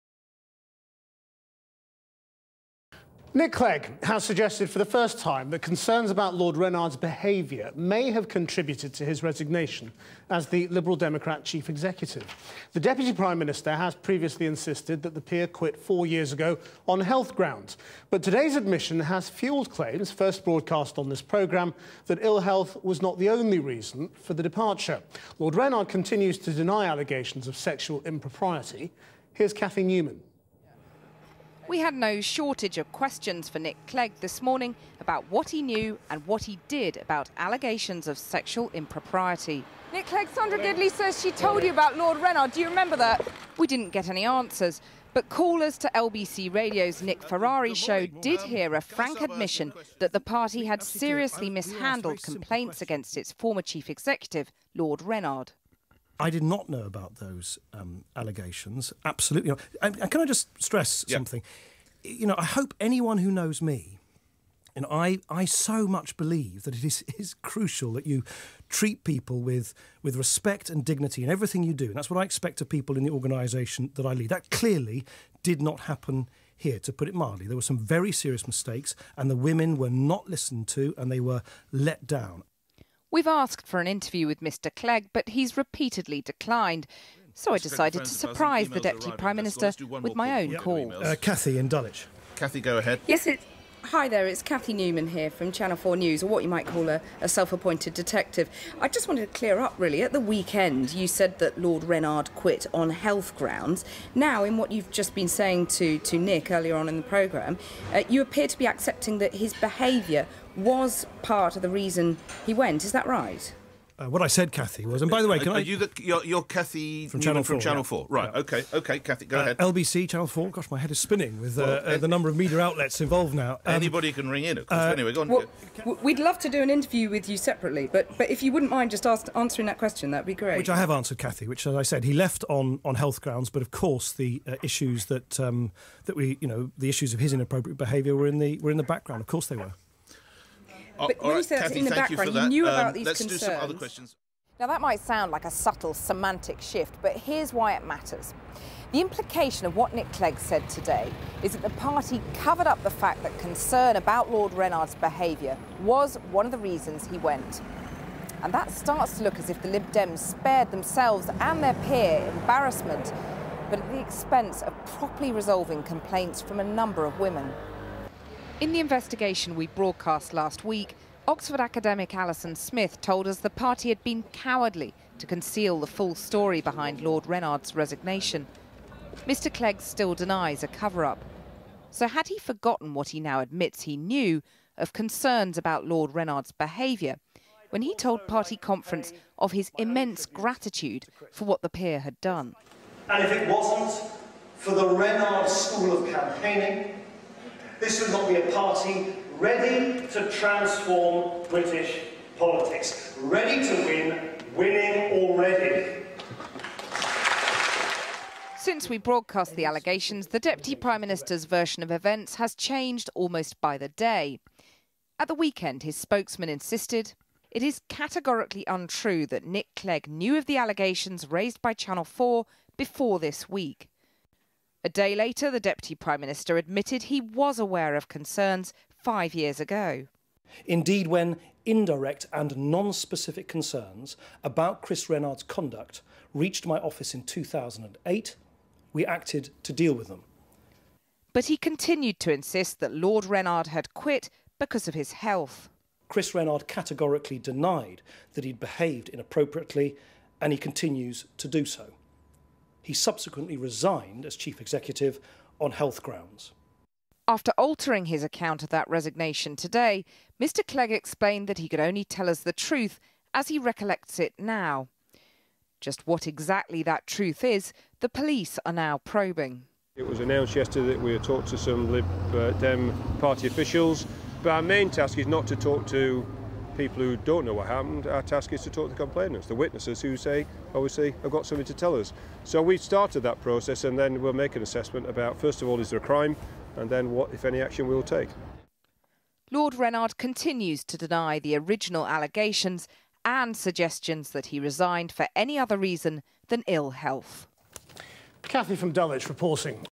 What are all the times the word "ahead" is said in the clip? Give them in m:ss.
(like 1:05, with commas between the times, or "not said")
1:32, 1:59.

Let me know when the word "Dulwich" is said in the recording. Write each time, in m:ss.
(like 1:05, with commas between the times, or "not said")
1:31, 4:58.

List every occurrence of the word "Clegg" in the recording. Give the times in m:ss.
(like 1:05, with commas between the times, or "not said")
0:03, 0:33, 0:40, 1:24, 2:30, 2:59, 3:39, 4:20.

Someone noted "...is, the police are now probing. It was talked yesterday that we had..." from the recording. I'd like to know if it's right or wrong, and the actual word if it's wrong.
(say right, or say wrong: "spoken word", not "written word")
wrong: "announced", not "talked".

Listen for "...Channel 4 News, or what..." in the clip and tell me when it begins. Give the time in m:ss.
1:35.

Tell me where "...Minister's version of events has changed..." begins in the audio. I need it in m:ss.
3:31.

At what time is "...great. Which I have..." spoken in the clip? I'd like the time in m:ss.
2:10.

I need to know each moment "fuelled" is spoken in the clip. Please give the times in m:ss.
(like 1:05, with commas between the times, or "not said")
0:19.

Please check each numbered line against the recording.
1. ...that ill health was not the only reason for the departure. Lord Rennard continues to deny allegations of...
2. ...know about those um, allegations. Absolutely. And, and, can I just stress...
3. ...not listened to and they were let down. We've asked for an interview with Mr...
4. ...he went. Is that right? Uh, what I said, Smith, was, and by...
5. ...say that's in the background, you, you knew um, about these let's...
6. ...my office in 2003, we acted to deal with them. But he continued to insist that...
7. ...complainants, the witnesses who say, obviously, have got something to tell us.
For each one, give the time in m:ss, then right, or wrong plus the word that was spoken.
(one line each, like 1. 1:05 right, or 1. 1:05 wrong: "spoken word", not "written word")
1. 0:22 right
2. 0:56 right
3. 1:19 right
4. 1:52 wrong: "Cathy", not "Smith"
5. 2:21 right
6. 3:56 wrong: "2008", not "2003"
7. 4:38 right.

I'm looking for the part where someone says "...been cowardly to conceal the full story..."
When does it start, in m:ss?
2:54.